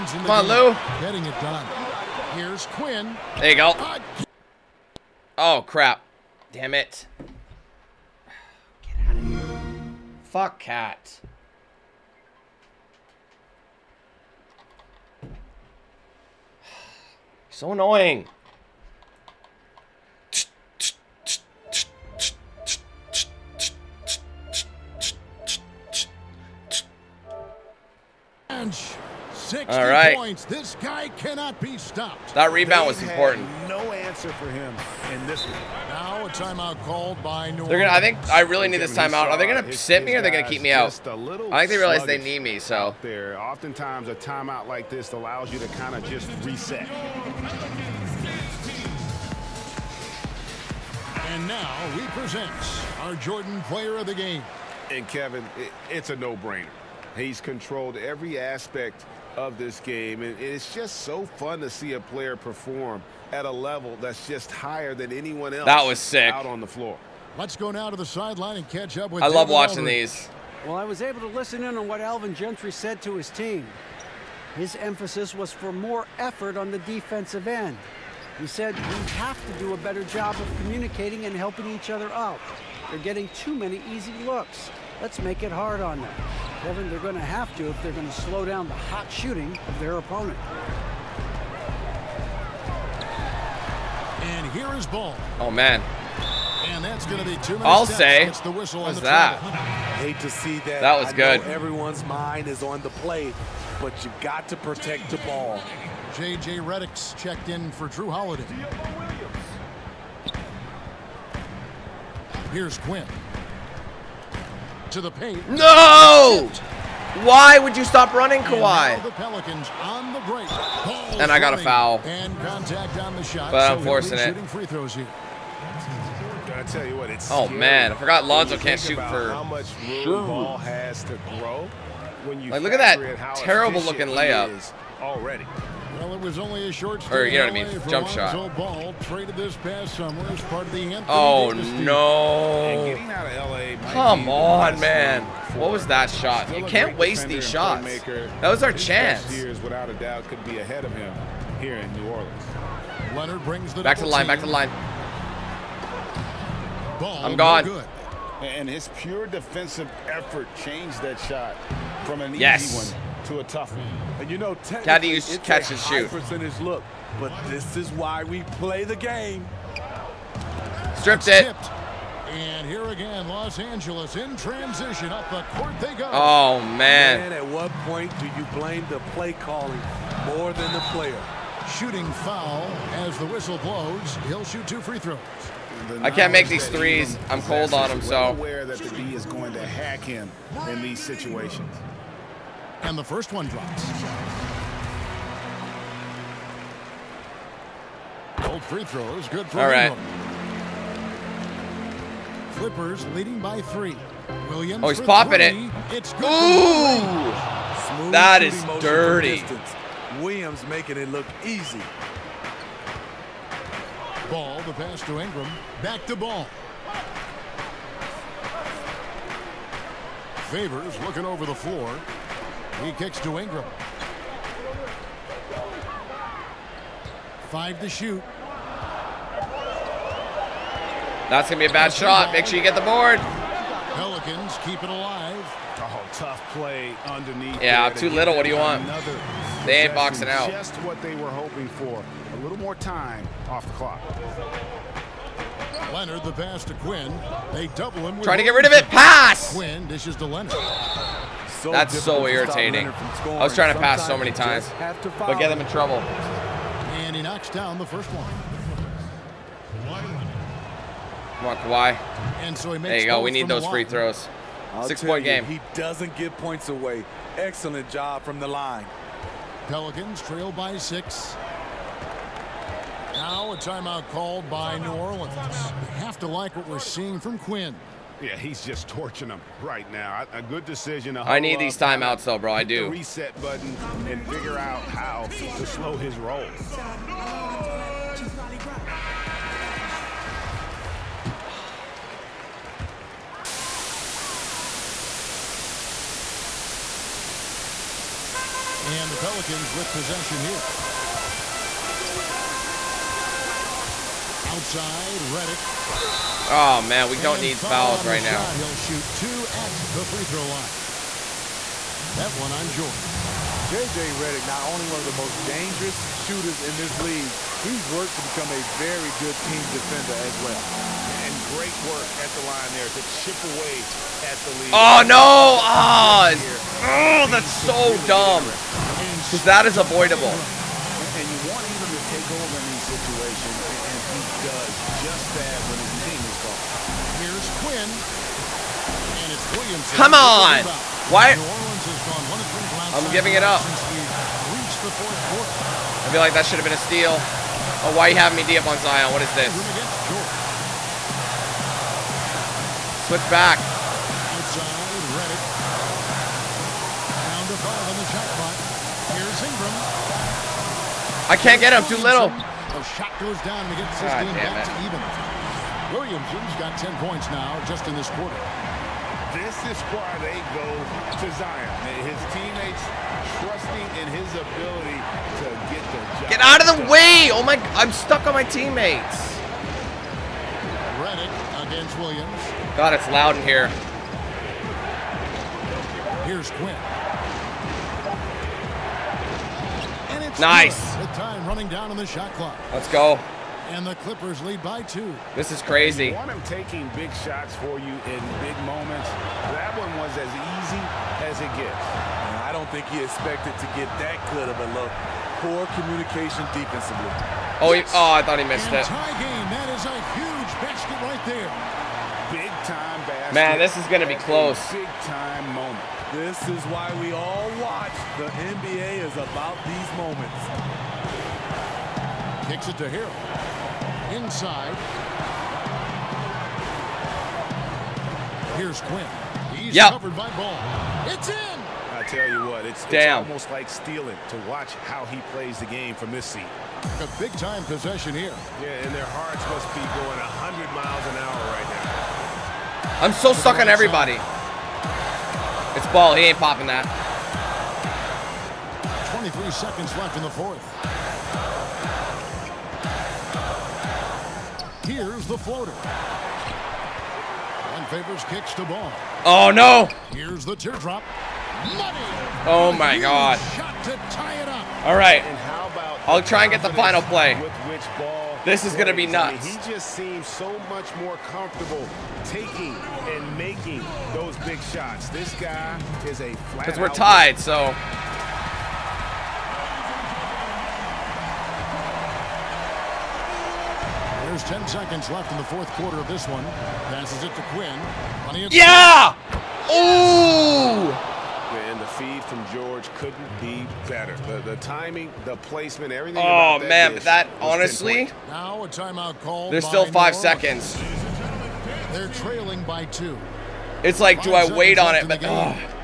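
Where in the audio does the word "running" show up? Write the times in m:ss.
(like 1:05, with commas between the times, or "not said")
1:58, 6:31.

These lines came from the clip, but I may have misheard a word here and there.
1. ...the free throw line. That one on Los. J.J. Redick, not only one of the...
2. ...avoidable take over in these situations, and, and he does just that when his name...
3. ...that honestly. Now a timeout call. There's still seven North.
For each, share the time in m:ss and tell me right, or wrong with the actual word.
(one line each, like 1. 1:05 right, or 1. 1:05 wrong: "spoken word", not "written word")
1. 5:09 wrong: "Jordan", not "Los"
2. 5:29 right
3. 8:17 wrong: "five", not "seven".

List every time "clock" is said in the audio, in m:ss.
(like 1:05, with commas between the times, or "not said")
4:03, 5:58, 6:32.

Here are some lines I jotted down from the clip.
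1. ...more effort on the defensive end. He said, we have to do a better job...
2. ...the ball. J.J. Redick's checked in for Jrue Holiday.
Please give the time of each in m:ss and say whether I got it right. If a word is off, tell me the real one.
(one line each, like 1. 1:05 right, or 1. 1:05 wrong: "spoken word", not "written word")
1. 1:15 right
2. 1:45 right.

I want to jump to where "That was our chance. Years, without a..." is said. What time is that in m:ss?
2:28.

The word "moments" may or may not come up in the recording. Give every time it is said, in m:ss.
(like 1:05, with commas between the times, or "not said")
6:38, 6:55, 6:59.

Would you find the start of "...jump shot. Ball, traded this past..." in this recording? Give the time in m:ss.
2:17.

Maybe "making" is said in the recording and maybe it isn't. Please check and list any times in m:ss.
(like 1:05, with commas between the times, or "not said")
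3:30, 7:53.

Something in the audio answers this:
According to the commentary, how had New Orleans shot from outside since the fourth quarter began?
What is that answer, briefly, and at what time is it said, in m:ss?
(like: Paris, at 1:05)
1 of 3, at 5:42.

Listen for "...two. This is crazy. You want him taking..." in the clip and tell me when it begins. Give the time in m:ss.
6:34.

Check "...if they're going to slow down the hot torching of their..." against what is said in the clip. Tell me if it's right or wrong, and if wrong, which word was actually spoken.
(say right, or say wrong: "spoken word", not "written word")
wrong: "shooting", not "torching".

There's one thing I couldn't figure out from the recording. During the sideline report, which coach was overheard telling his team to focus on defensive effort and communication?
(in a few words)
Alvin Gentry.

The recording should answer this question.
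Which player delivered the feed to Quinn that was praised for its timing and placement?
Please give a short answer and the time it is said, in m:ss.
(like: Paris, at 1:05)
George, at 8:12.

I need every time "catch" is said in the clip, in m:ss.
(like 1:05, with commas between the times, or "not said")
1:08, 2:45.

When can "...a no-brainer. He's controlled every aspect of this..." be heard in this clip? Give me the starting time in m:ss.
0:56.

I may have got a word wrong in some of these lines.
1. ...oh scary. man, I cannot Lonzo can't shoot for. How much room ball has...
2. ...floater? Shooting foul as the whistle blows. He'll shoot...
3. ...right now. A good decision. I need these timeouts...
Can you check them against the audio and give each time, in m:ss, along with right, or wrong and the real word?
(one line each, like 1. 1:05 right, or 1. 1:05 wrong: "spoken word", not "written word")
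1. 2:07 wrong: "forgot", not "cannot"
2. 3:00 wrong: "player", not "floater"
3. 4:39 right.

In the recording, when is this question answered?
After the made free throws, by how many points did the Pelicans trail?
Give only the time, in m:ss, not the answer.
4:30.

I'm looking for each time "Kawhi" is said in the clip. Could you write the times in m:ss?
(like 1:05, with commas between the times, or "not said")
1:58, 4:21.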